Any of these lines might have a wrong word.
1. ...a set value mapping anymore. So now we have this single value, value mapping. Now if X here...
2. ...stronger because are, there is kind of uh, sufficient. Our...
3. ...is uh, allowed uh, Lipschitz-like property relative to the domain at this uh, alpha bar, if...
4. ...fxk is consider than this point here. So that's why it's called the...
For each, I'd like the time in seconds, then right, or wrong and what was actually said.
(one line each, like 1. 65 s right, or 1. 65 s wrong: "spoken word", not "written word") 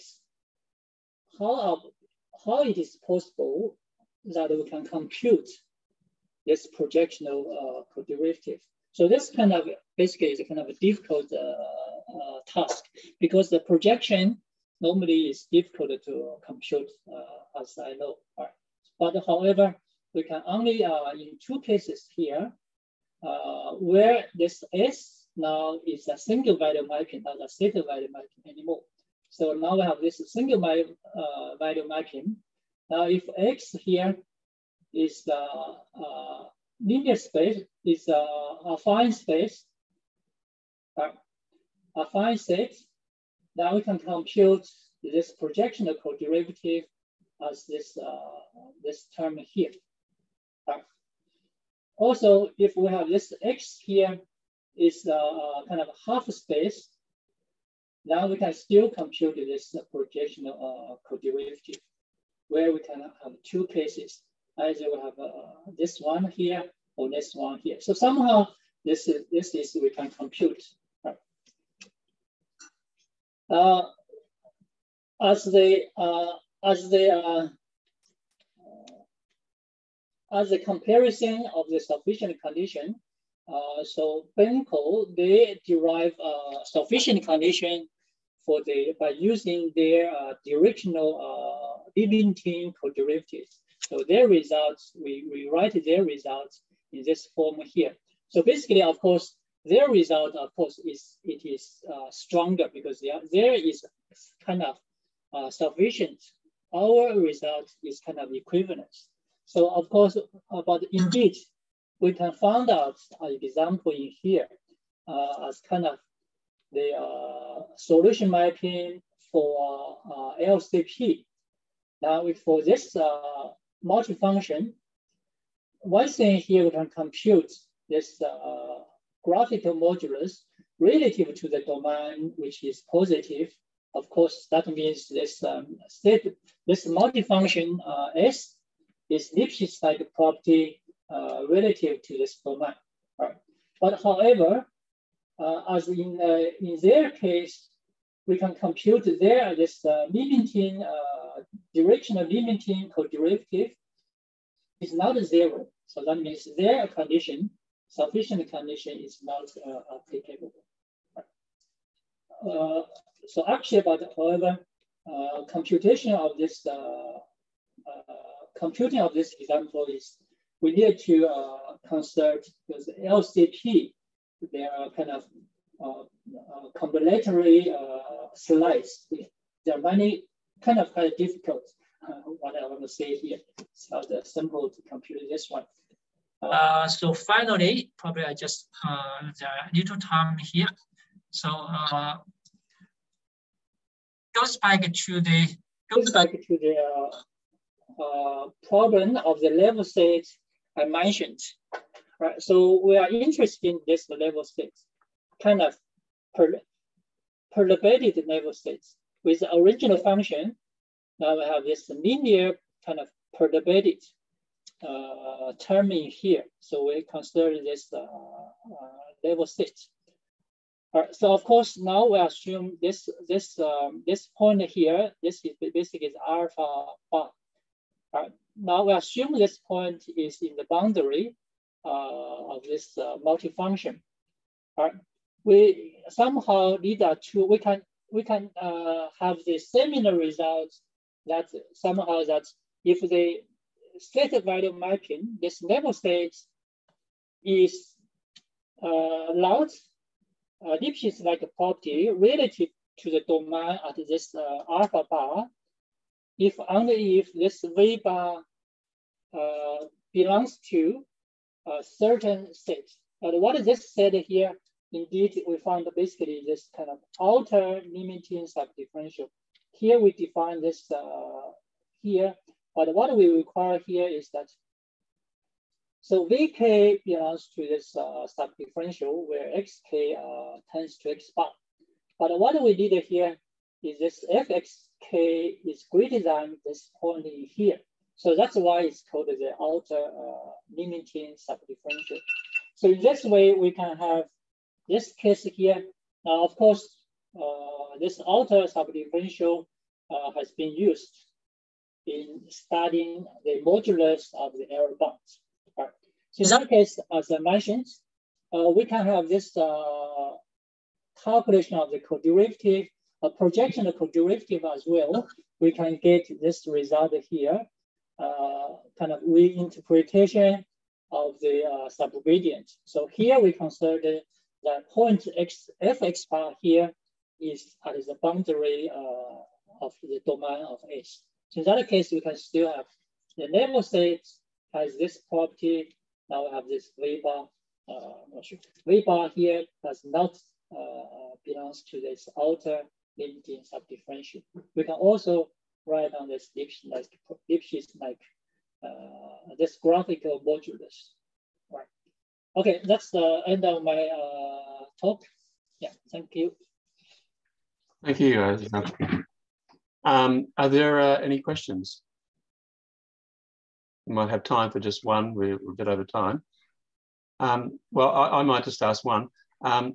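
1. 27 s right
2. 102 s right
3. 247 s right
4. 284 s wrong: "greater", not "consider".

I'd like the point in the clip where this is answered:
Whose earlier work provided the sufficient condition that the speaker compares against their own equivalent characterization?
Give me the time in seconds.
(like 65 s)
84 s.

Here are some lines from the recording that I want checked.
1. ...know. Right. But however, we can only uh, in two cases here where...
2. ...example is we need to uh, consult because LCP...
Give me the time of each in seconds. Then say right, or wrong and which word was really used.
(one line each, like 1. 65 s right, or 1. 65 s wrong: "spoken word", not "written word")
1. 17 s right
2. 169 s right.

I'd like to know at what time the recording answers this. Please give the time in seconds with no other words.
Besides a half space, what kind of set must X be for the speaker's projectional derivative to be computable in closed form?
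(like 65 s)
38 s.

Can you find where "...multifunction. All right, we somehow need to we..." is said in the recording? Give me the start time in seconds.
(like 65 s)
233 s.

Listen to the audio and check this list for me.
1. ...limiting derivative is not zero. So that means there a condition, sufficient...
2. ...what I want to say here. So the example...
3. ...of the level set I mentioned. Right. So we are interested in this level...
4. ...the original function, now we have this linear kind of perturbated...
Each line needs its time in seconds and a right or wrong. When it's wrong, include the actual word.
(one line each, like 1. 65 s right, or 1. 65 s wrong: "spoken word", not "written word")
1. 152 s right
2. 182 s wrong: "simple", not "example"
3. 199 s right
4. 209 s right.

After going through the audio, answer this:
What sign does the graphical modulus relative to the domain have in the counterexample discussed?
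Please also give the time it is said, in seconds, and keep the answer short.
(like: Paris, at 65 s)
positive, at 132 s.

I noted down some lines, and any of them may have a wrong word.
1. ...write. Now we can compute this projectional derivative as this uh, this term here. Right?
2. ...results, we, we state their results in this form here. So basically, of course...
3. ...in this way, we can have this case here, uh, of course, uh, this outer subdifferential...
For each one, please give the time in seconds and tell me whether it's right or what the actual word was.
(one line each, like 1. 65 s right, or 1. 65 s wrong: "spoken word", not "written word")
1. 42 s wrong: "state", not "write"
2. 94 s wrong: "write", not "state"
3. 292 s right.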